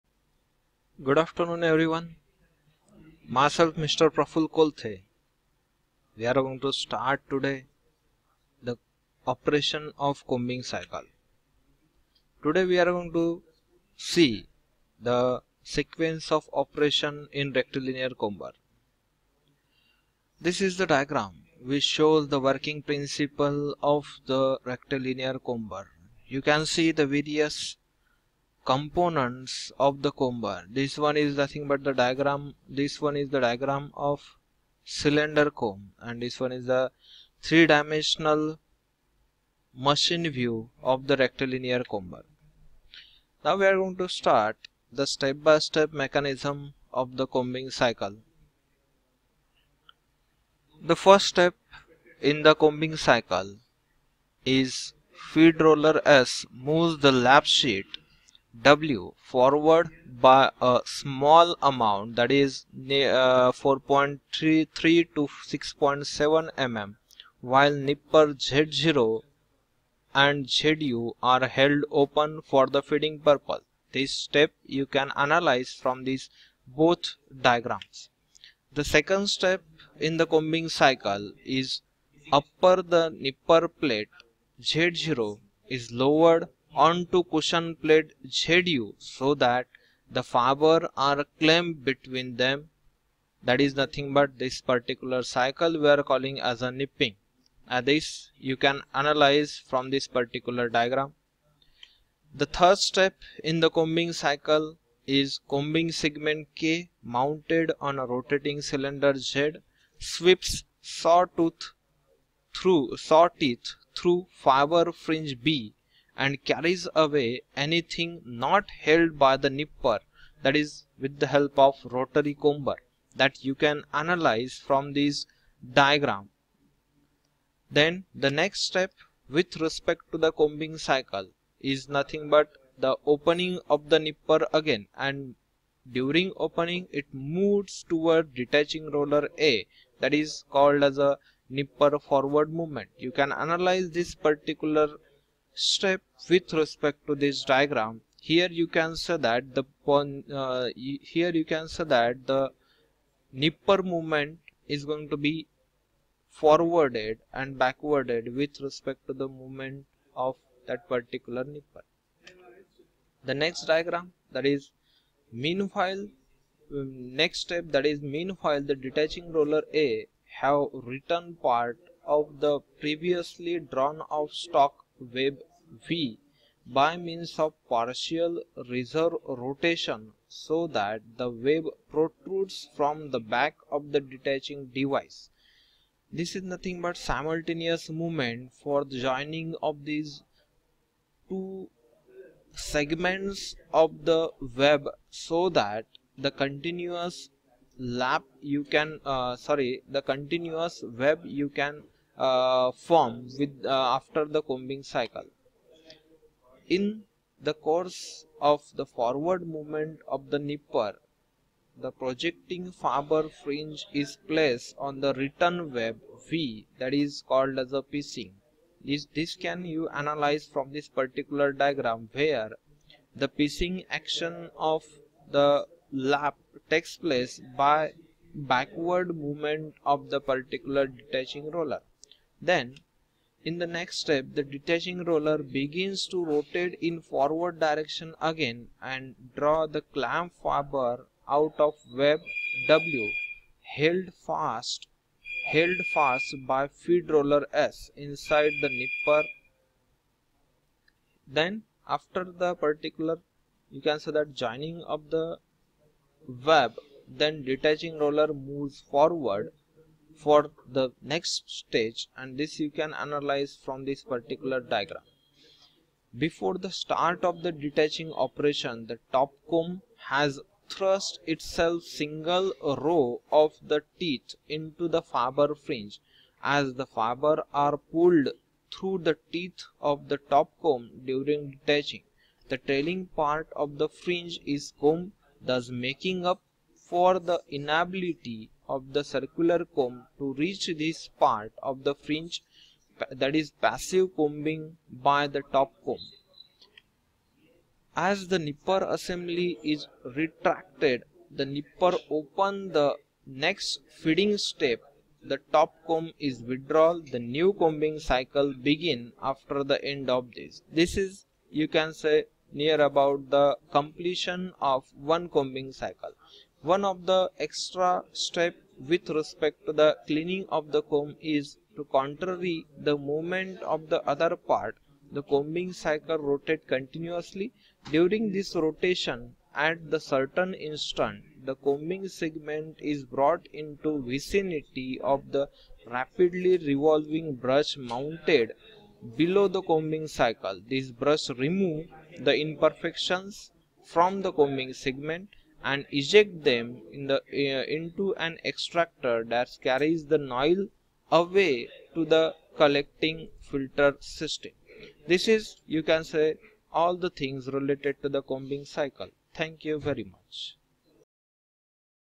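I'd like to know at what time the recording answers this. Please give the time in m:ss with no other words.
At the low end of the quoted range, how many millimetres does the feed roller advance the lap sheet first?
1:03.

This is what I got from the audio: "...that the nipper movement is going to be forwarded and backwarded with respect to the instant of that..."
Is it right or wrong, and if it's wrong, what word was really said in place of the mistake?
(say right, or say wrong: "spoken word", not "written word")
wrong: "movement", not "instant".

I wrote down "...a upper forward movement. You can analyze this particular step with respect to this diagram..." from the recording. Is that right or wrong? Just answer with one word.
wrong.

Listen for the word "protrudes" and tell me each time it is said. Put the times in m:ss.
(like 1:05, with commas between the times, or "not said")
3:01.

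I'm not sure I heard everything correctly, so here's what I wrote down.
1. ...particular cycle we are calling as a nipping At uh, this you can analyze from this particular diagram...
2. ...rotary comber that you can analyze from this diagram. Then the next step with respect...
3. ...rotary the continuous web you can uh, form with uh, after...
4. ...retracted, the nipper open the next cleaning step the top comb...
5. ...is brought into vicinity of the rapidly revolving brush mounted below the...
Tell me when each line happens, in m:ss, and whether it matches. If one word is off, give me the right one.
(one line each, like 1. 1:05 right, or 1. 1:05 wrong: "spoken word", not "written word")
1. 1:34 right
2. 2:01 right
3. 3:19 wrong: "sorry", not "rotary"
4. 5:00 wrong: "feeding", not "cleaning"
5. 5:32 right.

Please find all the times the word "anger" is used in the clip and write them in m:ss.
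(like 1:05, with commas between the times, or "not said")
not said.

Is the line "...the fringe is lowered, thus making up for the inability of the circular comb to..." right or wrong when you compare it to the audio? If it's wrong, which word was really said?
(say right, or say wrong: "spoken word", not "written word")
wrong: "combed", not "lowered".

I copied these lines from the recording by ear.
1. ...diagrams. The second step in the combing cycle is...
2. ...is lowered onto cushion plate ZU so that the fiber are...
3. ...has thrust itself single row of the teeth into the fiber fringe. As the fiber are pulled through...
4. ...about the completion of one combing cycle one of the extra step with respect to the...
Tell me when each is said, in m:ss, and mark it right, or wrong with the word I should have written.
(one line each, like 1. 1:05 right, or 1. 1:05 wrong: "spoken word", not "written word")
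1. 1:17 right
2. 1:25 right
3. 4:30 right
4. 5:12 right.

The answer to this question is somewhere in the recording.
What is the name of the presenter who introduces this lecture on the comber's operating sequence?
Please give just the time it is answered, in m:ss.
0:04.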